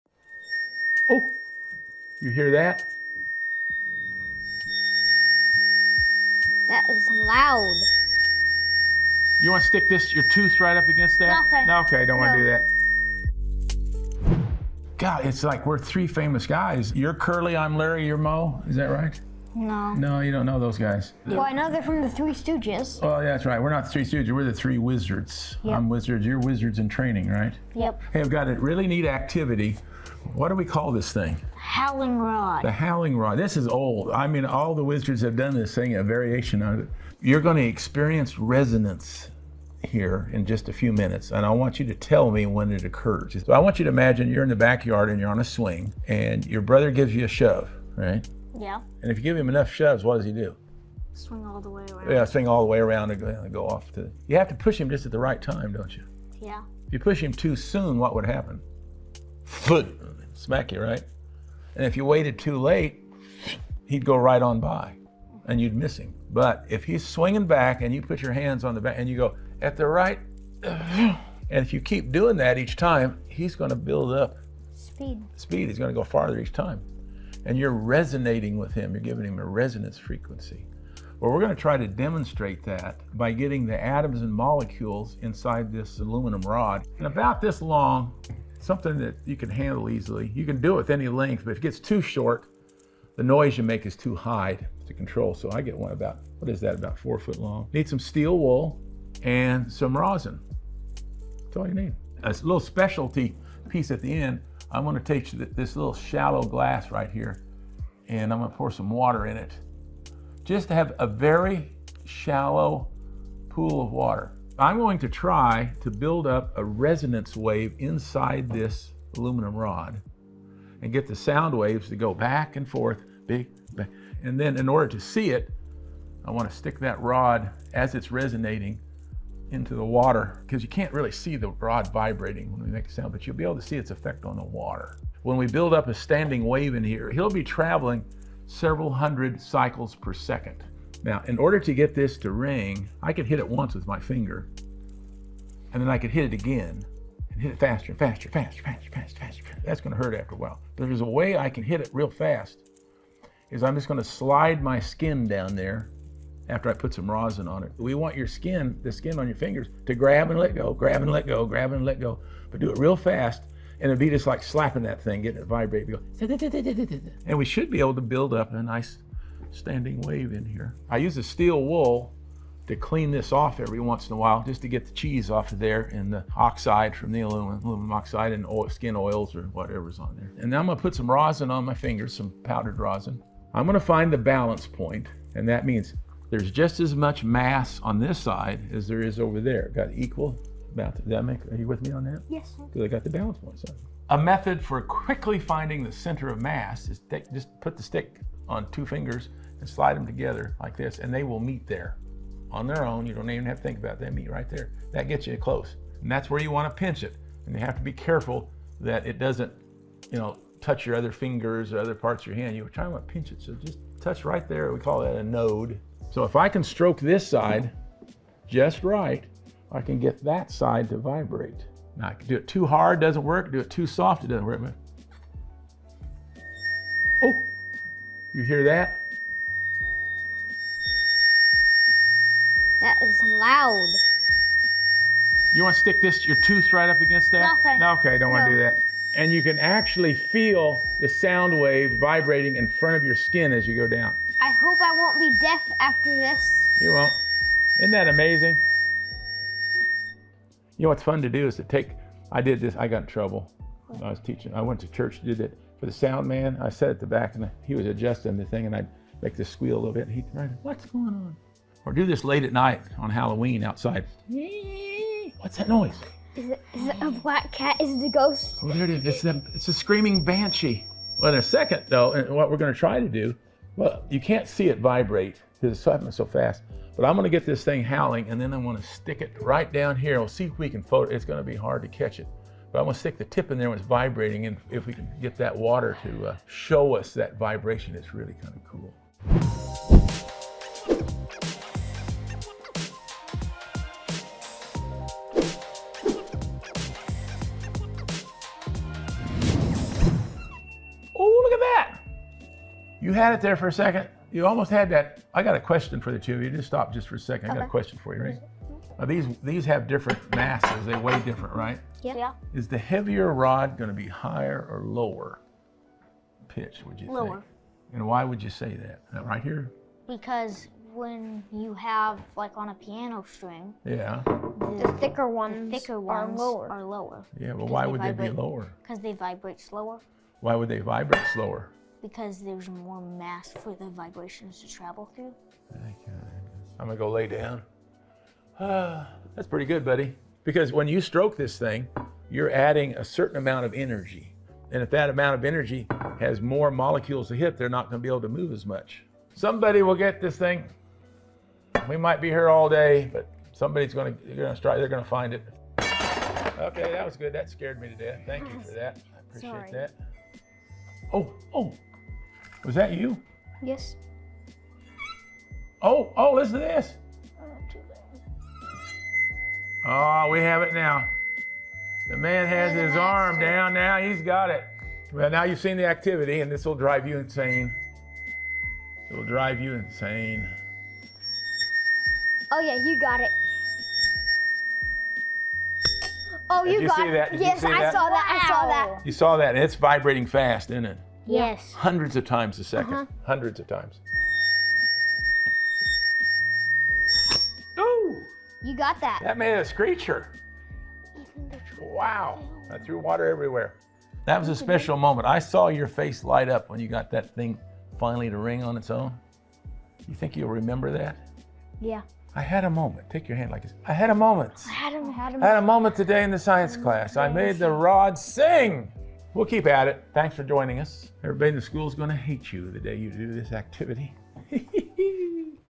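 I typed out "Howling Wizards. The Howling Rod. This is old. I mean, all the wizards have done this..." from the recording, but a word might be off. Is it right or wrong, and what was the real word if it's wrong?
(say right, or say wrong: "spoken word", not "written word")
wrong: "Rod", not "Wizards".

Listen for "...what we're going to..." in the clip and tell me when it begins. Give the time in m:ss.
4:32.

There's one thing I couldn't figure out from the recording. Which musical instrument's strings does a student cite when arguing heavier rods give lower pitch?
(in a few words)
piano.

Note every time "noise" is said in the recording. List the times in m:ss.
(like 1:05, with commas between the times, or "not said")
1:33, 4:25.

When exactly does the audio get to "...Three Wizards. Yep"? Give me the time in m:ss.
0:24.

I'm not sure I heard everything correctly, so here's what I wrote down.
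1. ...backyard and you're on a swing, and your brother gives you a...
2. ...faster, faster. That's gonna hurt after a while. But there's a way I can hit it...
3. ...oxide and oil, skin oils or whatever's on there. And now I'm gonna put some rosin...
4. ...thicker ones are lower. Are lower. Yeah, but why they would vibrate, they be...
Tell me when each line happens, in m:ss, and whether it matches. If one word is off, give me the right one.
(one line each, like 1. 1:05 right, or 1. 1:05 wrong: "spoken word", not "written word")
1. 0:44 right
2. 2:28 right
3. 2:57 right
4. 5:25 right.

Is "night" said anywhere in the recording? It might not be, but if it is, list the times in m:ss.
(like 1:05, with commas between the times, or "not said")
4:22.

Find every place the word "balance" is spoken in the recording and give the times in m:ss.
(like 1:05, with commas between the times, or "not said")
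3:04, 3:13.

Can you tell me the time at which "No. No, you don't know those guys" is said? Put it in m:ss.
0:19.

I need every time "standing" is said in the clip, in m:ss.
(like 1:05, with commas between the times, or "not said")
2:15, 2:49.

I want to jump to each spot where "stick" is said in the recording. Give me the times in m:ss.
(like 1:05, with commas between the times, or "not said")
0:09, 2:06, 3:17, 3:55, 4:38, 4:42.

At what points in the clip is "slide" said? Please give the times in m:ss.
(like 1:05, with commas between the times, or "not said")
2:34, 3:19.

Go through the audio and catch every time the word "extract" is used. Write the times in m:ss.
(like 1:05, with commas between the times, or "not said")
not said.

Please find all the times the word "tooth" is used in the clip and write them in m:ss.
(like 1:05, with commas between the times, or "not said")
0:10, 3:56.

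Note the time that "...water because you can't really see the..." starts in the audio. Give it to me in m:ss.
2:09.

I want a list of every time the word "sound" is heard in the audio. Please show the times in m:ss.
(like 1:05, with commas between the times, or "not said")
2:01, 2:12, 4:01, 4:15.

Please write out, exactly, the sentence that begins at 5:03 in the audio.
You had it there for a second.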